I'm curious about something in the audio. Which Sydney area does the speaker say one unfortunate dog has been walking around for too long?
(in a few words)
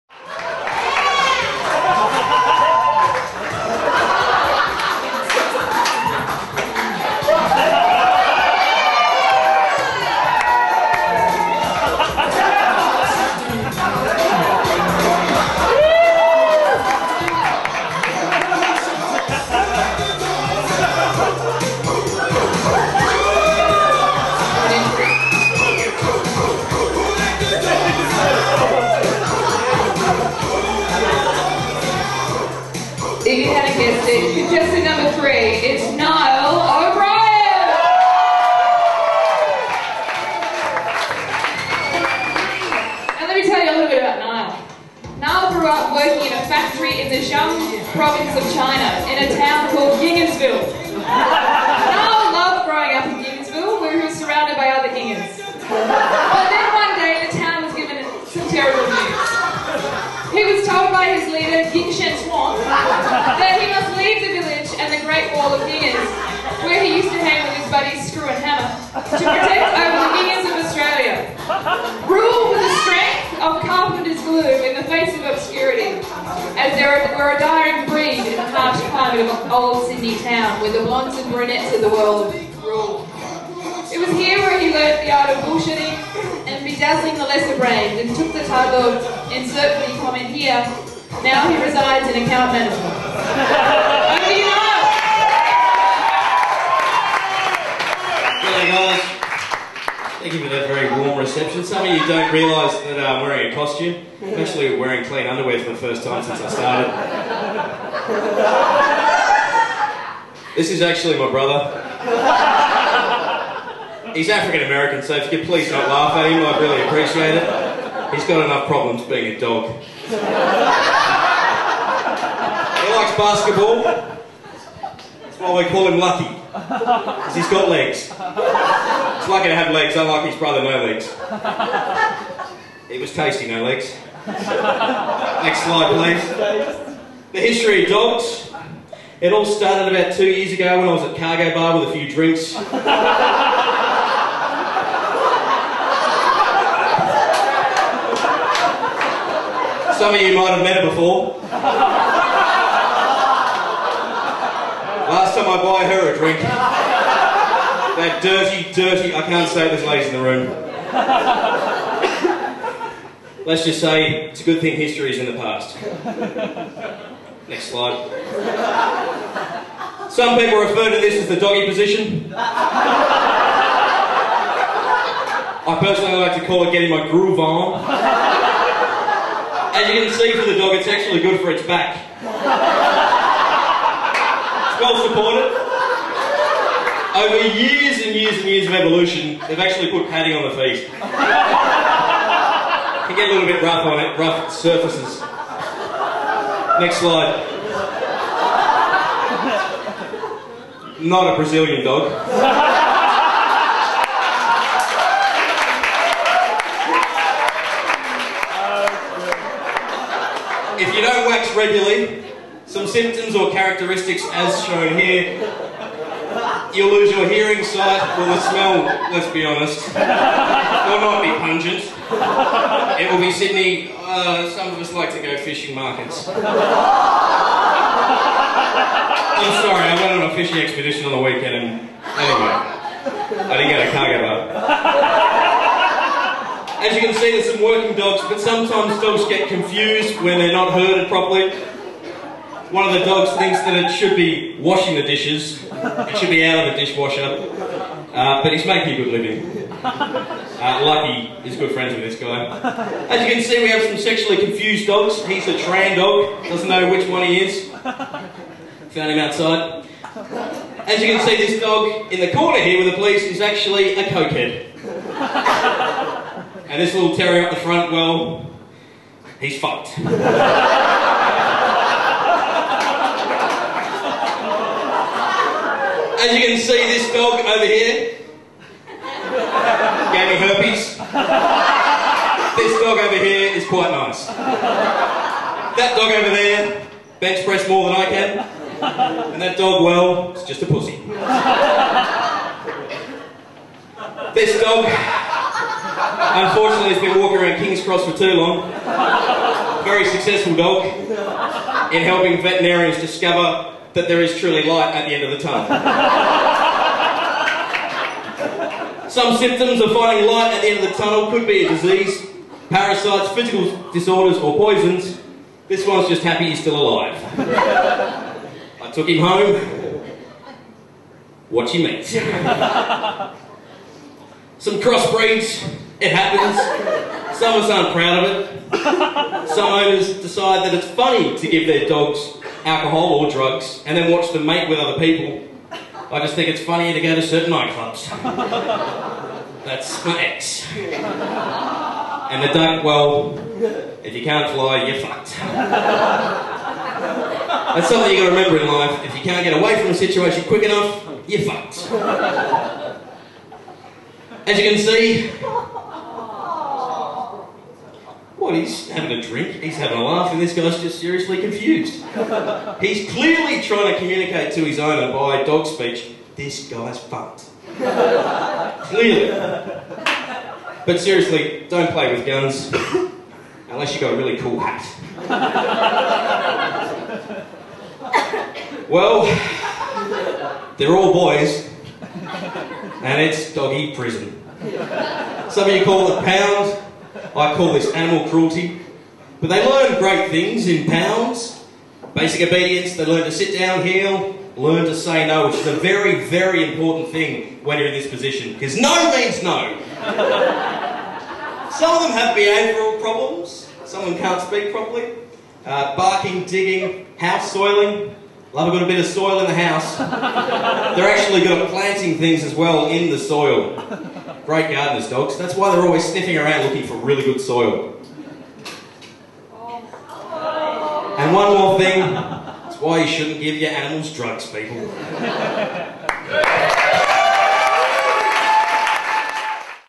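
King's Cross.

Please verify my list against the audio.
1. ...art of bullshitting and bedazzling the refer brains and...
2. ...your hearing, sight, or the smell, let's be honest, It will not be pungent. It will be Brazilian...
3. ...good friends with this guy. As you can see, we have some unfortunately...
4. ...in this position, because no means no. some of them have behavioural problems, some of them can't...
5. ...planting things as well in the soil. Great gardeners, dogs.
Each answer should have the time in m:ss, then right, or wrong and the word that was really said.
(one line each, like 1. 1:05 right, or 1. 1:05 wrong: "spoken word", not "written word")
1. 1:25 wrong: "lesser", not "refer"
2. 3:37 wrong: "Sydney", not "Brazilian"
3. 4:11 wrong: "sexually", not "unfortunately"
4. 6:37 right
5. 6:51 right.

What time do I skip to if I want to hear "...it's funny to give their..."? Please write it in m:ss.
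5:30.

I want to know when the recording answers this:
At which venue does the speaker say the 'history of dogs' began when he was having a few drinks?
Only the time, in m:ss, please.
2:21.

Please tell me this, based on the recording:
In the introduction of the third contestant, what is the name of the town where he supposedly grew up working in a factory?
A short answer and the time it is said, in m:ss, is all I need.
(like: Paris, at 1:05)
Yingansville, at 0:49.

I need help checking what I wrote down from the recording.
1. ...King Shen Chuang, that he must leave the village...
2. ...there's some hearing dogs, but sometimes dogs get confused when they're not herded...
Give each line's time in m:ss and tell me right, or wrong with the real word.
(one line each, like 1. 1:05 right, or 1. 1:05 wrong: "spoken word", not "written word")
1. 1:01 right
2. 3:57 wrong: "working", not "hearing".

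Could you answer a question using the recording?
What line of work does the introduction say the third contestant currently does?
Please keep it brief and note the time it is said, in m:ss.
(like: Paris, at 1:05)
account management, at 1:32.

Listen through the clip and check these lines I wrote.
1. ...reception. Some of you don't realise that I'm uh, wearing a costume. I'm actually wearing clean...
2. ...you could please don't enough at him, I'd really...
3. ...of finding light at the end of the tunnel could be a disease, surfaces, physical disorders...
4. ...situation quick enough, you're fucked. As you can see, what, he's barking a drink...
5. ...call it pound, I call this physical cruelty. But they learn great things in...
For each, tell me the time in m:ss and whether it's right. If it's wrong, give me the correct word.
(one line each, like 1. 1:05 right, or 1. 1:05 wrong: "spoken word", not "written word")
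1. 1:41 right
2. 1:55 wrong: "laugh", not "enough"
3. 5:09 wrong: "parasites", not "surfaces"
4. 5:49 wrong: "having", not "barking"
5. 6:25 wrong: "animal", not "physical".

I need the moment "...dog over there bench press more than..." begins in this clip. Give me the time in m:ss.
4:45.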